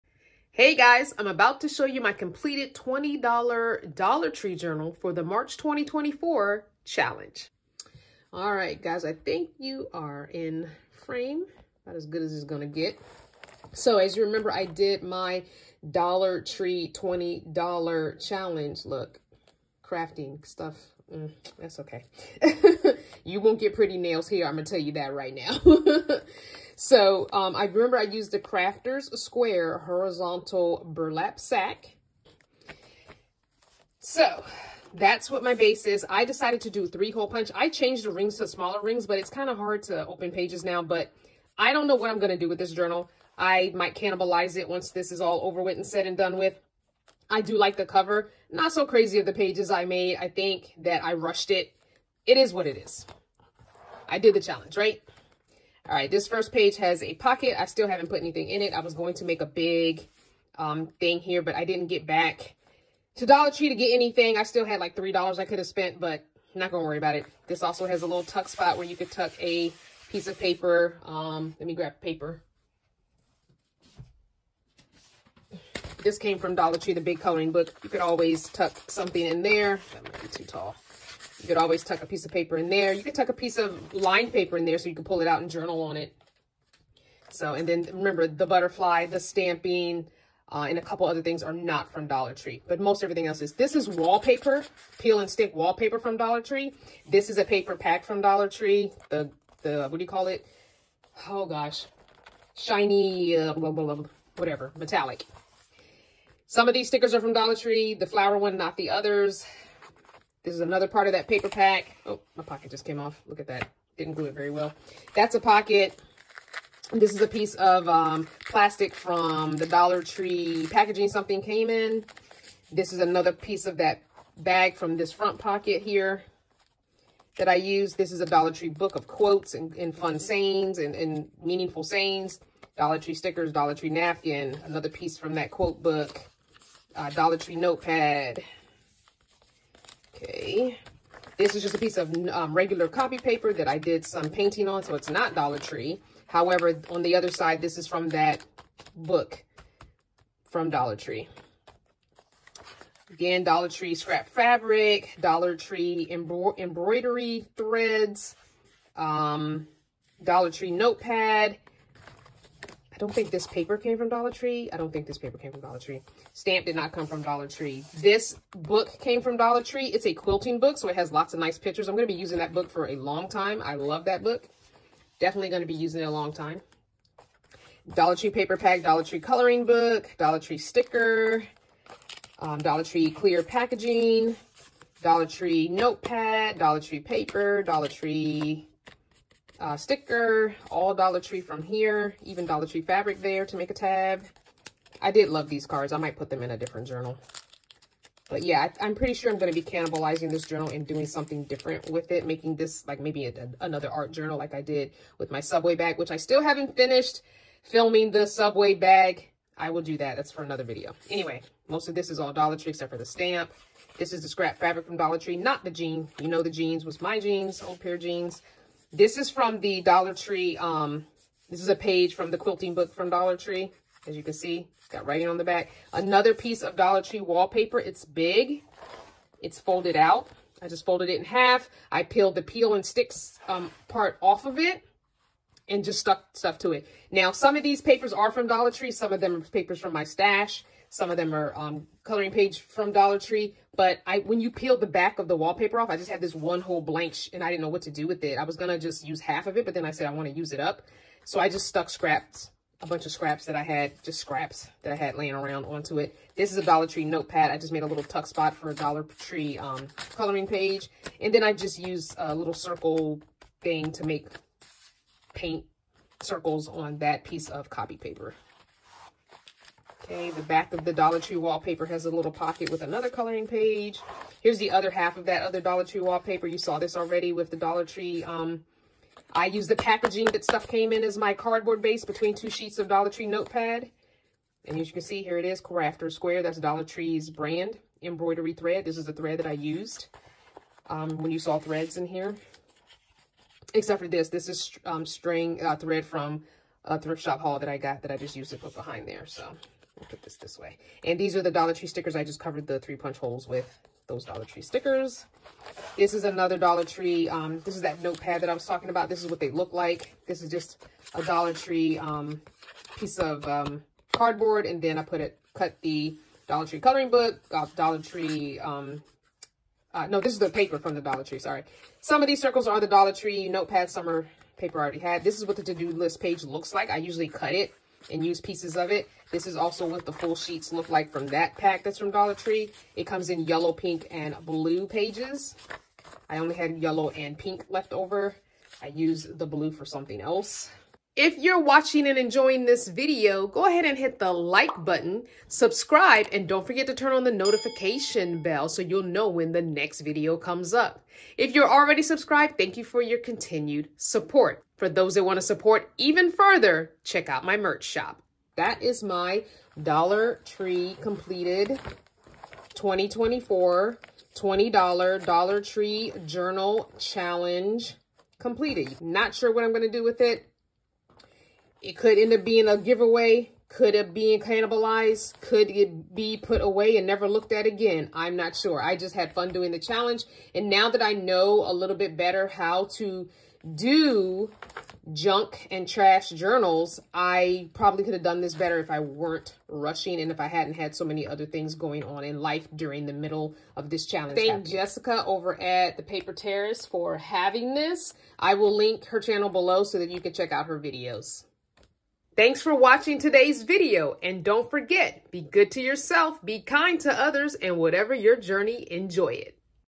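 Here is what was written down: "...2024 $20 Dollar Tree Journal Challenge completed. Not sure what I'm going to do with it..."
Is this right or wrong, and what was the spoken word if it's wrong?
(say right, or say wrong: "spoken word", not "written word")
right.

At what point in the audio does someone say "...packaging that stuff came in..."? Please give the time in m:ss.
4:39.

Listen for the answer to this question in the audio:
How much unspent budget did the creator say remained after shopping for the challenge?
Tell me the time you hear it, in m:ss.
1:04.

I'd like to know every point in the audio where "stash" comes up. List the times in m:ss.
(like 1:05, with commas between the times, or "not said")
4:00.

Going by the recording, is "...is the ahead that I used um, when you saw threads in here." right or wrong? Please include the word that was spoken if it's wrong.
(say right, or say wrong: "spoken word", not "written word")
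wrong: "thread", not "ahead".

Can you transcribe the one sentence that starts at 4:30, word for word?
Okay, the back of the Dollar Tree wallpaper has a little pocket with another coloring page.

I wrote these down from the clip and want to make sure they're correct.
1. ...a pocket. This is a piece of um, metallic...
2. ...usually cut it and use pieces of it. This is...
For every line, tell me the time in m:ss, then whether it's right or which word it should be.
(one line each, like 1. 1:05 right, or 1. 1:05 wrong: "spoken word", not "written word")
1. 1:55 wrong: "plastic", not "metallic"
2. 5:26 right.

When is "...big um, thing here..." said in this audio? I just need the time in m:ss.
0:59.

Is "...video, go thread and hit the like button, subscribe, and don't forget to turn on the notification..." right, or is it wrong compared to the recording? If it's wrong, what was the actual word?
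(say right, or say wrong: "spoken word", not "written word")
wrong: "ahead", not "thread".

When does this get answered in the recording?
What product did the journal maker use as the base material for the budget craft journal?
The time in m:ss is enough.
0:30.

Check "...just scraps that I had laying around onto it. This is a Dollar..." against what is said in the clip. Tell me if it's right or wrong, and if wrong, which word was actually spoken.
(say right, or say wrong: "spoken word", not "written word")
right.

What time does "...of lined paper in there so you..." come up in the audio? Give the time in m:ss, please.
1:23.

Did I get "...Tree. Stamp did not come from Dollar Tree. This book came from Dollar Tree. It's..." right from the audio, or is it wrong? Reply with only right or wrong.
right.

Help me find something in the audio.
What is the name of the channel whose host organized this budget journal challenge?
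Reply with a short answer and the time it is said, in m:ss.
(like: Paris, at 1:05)
The Paper Terrace, at 6:35.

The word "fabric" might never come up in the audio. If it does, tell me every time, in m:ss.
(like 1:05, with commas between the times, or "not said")
2:34, 3:12, 3:34.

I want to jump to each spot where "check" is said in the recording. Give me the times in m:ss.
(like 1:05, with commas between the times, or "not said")
5:57, 6:40.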